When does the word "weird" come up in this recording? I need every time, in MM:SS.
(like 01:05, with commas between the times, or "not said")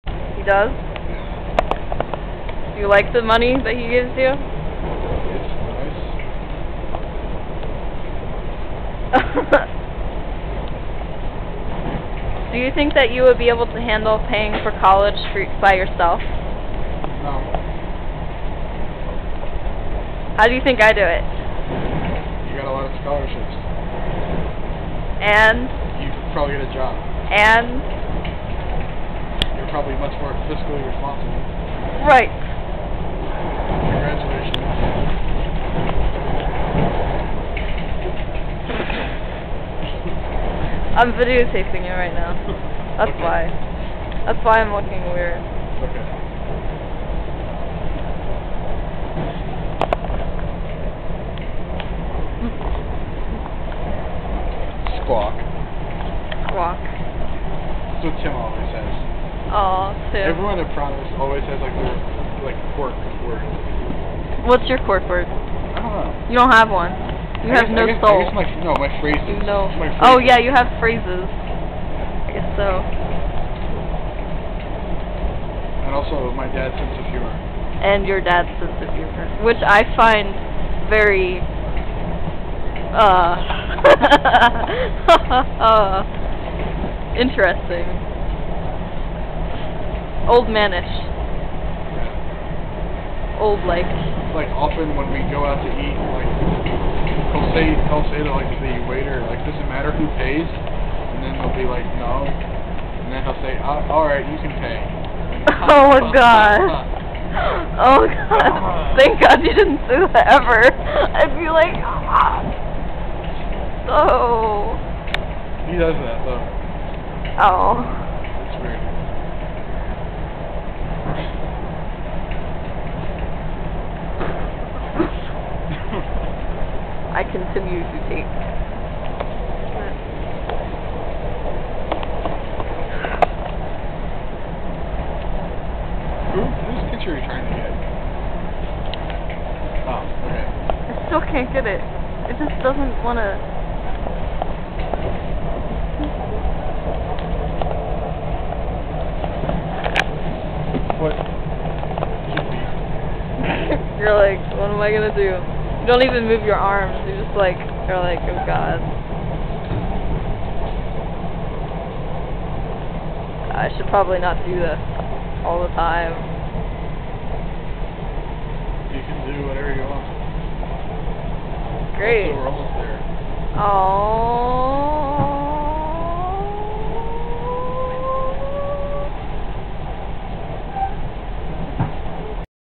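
00:45, 01:58.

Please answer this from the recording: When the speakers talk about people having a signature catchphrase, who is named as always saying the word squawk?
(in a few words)
Tim.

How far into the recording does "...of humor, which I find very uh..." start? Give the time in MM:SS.
01:18.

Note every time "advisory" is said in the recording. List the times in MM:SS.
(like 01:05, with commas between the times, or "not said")
not said.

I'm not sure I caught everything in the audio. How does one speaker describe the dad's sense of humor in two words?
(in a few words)
Old manish.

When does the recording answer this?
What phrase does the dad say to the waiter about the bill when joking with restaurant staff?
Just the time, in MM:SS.
01:39.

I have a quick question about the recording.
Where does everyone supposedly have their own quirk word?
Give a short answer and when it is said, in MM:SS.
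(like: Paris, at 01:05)
Promise, at 01:00.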